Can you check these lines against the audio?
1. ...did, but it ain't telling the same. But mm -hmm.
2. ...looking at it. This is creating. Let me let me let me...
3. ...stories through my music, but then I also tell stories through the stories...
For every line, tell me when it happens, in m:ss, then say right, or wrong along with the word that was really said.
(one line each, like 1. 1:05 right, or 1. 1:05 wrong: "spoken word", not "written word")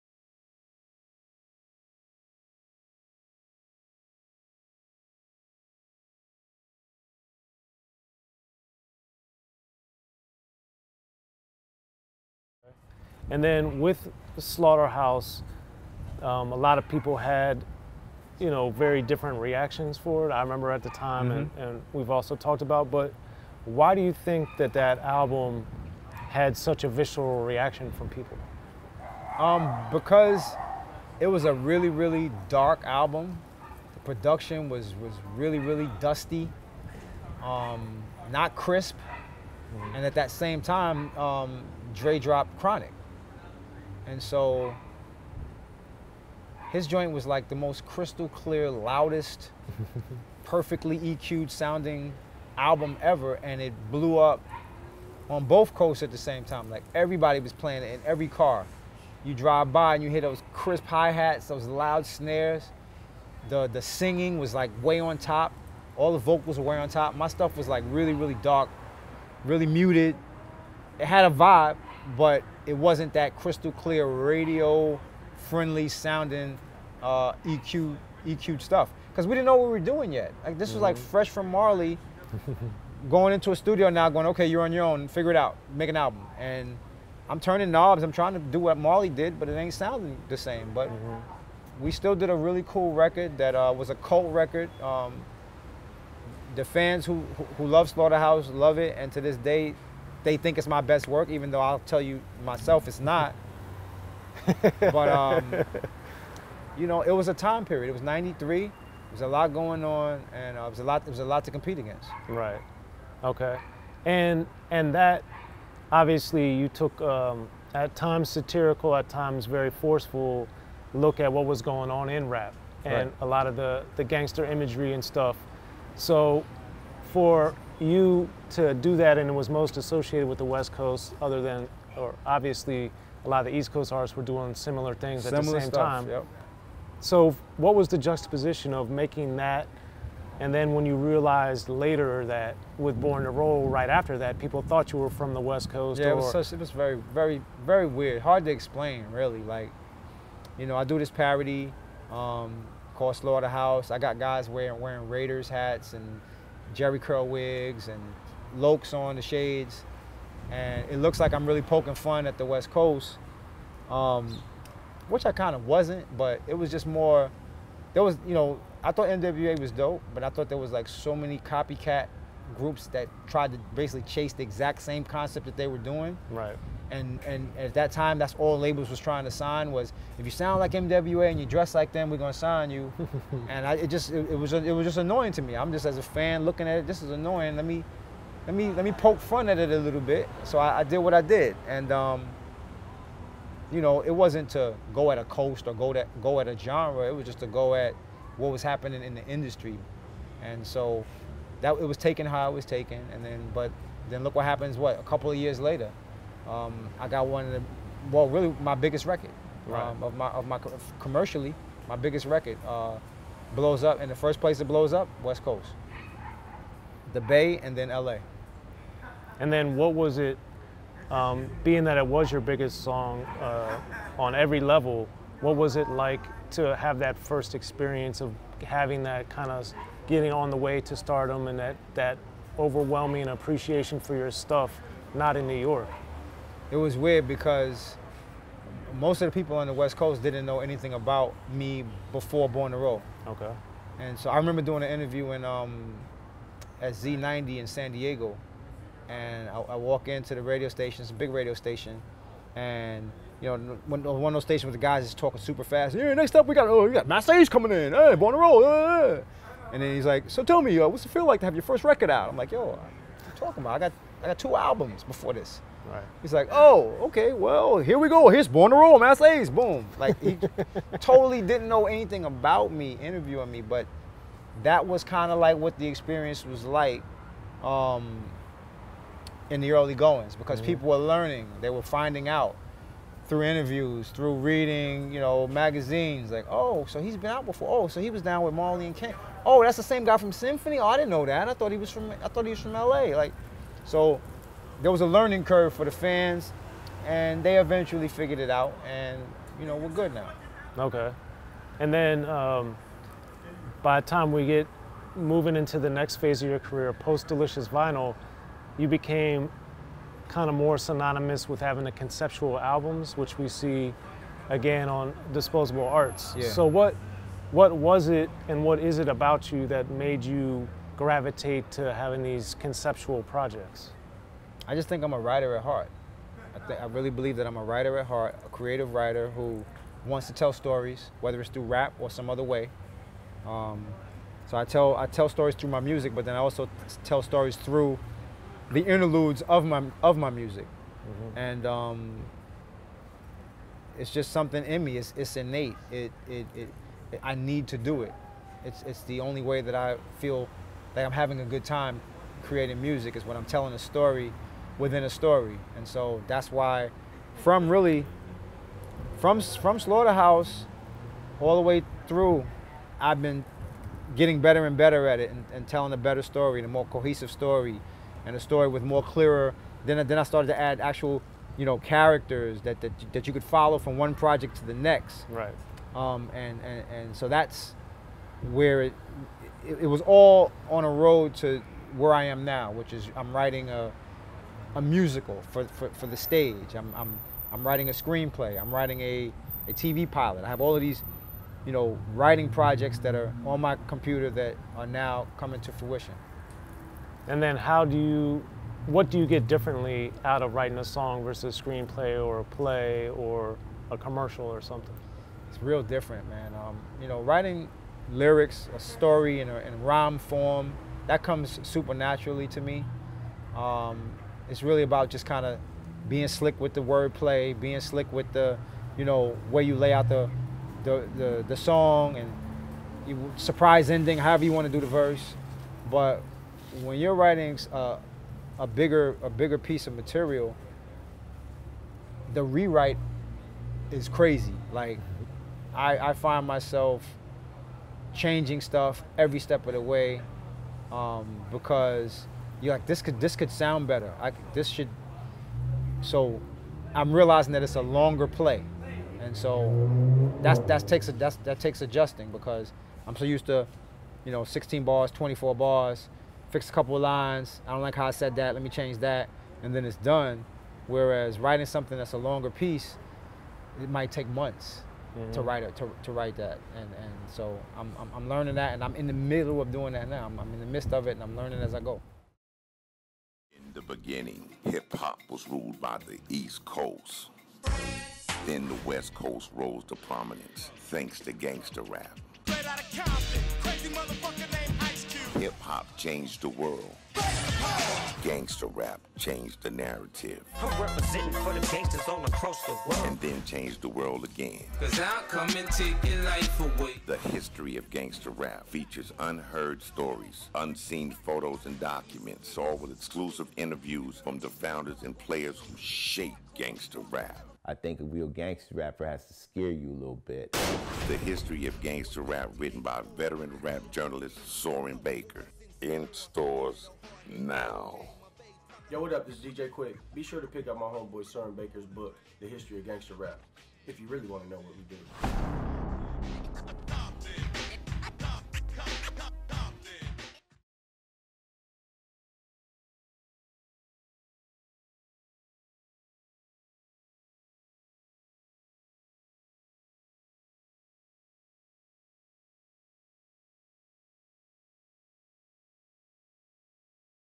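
1. 1:29 wrong: "sounding", not "telling"
2. 3:06 wrong: "annoying", not "creating"
3. 5:35 wrong: "interludes", not "stories".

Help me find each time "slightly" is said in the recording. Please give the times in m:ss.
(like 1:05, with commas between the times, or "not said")
not said.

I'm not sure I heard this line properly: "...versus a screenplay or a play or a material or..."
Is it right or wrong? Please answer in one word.
wrong.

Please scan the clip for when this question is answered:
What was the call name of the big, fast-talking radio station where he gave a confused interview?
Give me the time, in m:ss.
4:06.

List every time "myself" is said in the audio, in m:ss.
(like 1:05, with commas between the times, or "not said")
1:42, 7:16.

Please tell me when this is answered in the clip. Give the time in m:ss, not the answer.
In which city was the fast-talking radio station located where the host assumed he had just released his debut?
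4:07.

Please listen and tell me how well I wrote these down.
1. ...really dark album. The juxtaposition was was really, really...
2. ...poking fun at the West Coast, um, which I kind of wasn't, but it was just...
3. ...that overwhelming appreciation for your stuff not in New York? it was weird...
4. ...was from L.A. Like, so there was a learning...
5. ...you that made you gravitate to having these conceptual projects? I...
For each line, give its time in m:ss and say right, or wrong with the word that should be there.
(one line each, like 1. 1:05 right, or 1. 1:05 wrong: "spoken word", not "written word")
1. 0:31 wrong: "production", not "juxtaposition"
2. 2:41 right
3. 3:51 right
4. 4:52 right
5. 5:19 right.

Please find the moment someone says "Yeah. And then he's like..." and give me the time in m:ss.
4:18.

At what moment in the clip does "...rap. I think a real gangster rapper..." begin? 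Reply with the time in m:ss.
8:27.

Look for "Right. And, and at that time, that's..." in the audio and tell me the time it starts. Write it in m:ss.
2:56.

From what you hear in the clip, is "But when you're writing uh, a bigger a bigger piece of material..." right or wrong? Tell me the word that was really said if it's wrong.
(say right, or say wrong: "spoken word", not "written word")
right.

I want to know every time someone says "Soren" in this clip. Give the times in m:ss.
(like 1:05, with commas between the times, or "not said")
8:34, 8:41.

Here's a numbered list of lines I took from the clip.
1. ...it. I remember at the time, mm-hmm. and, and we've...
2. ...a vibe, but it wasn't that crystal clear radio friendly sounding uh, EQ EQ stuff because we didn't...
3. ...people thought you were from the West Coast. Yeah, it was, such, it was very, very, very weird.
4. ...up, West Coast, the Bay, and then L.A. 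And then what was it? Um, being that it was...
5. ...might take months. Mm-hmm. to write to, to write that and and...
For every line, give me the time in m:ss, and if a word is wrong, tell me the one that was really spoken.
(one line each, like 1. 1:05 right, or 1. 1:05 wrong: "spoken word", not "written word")
1. 0:20 right
2. 1:11 right
3. 2:24 right
4. 3:34 right
5. 7:43 right.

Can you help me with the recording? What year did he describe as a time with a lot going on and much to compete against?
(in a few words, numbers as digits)
1993.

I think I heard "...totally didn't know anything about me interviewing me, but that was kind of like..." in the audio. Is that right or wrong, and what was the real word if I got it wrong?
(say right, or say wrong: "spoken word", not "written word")
right.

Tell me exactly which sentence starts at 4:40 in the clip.
people were learning, they were finding out through interviews, through reading, you know, magazines.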